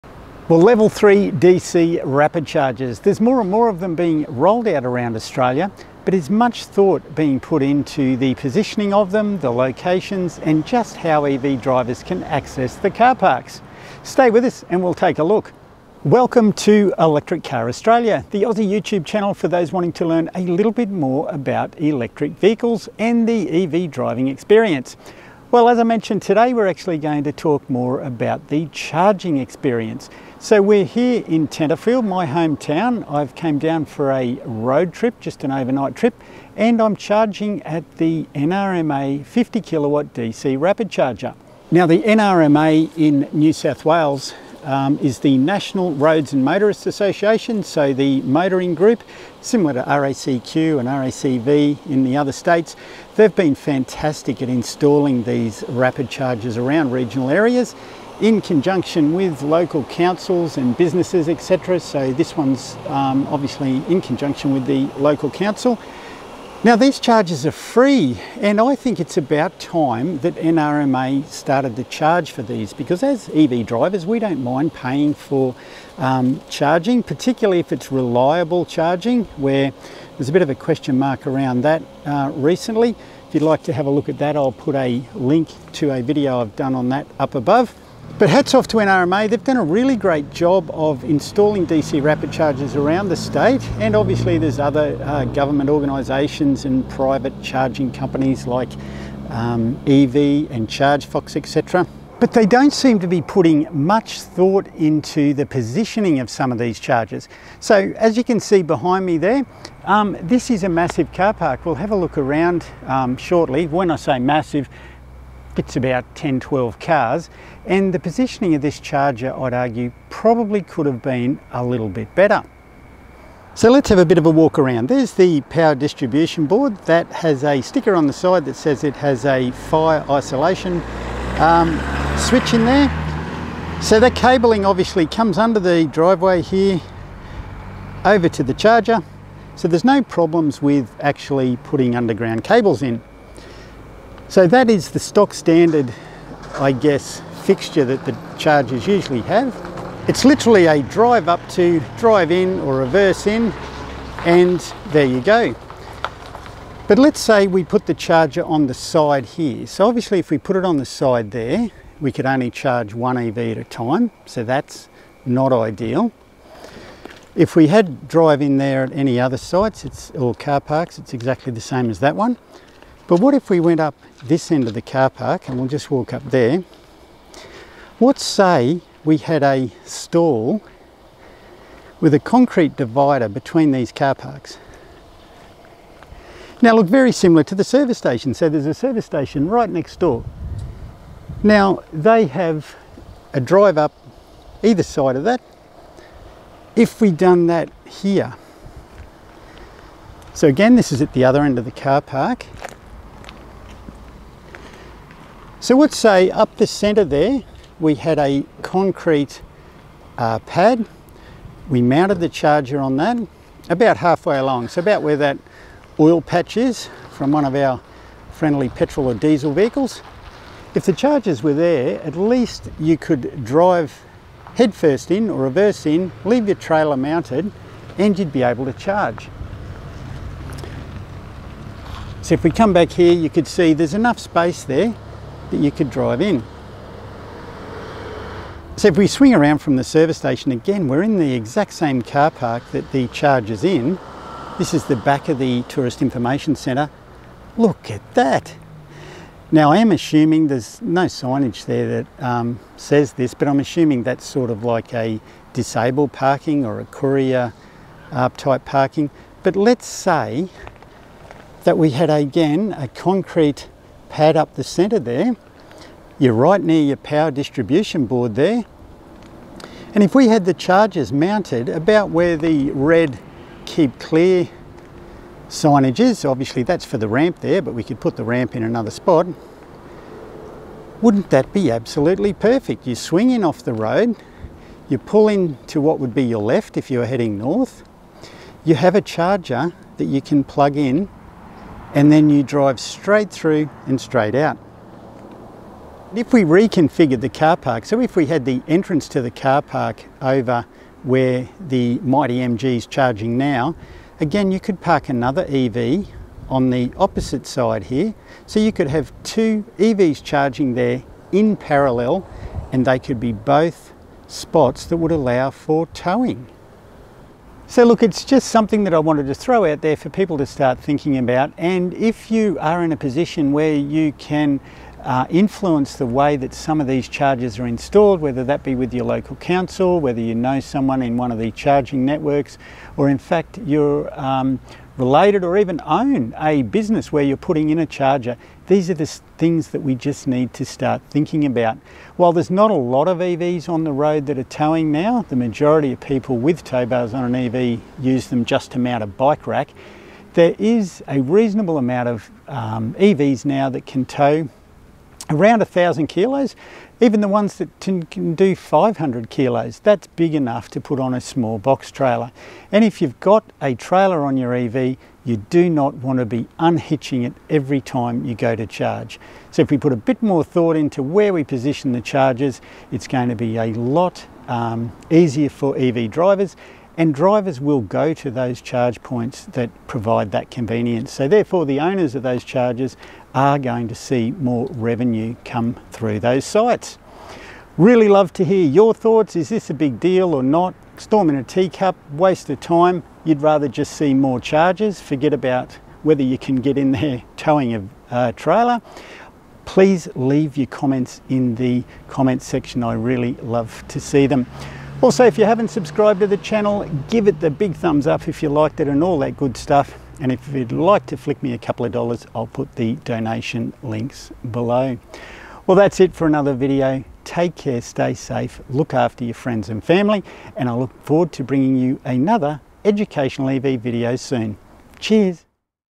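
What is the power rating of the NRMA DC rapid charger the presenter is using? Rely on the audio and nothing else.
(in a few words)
50 kilowatts.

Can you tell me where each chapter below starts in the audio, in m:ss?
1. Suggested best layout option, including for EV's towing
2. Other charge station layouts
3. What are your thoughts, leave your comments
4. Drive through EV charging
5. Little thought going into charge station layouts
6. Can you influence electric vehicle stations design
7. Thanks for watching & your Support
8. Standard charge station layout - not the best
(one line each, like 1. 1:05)
1. 4:00
2. 2:55
3. 6:29
4. 4:50
5. 1:40
6. 5:20
7. 6:44
8. 2:30.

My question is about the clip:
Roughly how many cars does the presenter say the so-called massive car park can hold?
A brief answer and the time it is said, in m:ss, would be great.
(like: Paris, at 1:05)
10 to 12, at 1:56.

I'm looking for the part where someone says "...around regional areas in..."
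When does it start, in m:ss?
0:56.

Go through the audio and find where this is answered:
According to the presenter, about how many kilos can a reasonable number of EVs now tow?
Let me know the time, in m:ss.
5:55.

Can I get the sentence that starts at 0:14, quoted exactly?
Stay with us and we'll take a look.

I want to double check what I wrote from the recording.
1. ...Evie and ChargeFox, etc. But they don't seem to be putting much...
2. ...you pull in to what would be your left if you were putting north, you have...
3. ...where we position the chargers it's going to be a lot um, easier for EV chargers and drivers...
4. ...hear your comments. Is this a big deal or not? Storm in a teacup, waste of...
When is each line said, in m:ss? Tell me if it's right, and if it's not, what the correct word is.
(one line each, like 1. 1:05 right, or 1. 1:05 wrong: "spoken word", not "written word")
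1. 1:39 right
2. 4:44 wrong: "heading", not "putting"
3. 6:11 wrong: "drivers", not "chargers"
4. 6:28 wrong: "thoughts", not "comments".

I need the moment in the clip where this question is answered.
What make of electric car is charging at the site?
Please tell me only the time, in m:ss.
5:02.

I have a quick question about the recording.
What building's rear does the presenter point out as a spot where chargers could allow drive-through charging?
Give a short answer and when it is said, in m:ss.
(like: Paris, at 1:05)
Tourist Information Centre, at 4:05.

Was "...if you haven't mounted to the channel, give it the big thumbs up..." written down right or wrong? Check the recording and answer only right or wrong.
wrong.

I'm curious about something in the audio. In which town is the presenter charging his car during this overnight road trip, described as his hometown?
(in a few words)
Tenterfield.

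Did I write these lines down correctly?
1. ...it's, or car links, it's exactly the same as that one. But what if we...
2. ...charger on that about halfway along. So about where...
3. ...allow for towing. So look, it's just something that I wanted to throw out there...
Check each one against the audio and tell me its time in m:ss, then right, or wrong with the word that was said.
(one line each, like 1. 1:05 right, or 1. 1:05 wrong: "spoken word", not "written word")
1. 2:49 wrong: "parks", not "links"
2. 3:32 right
3. 5:15 right.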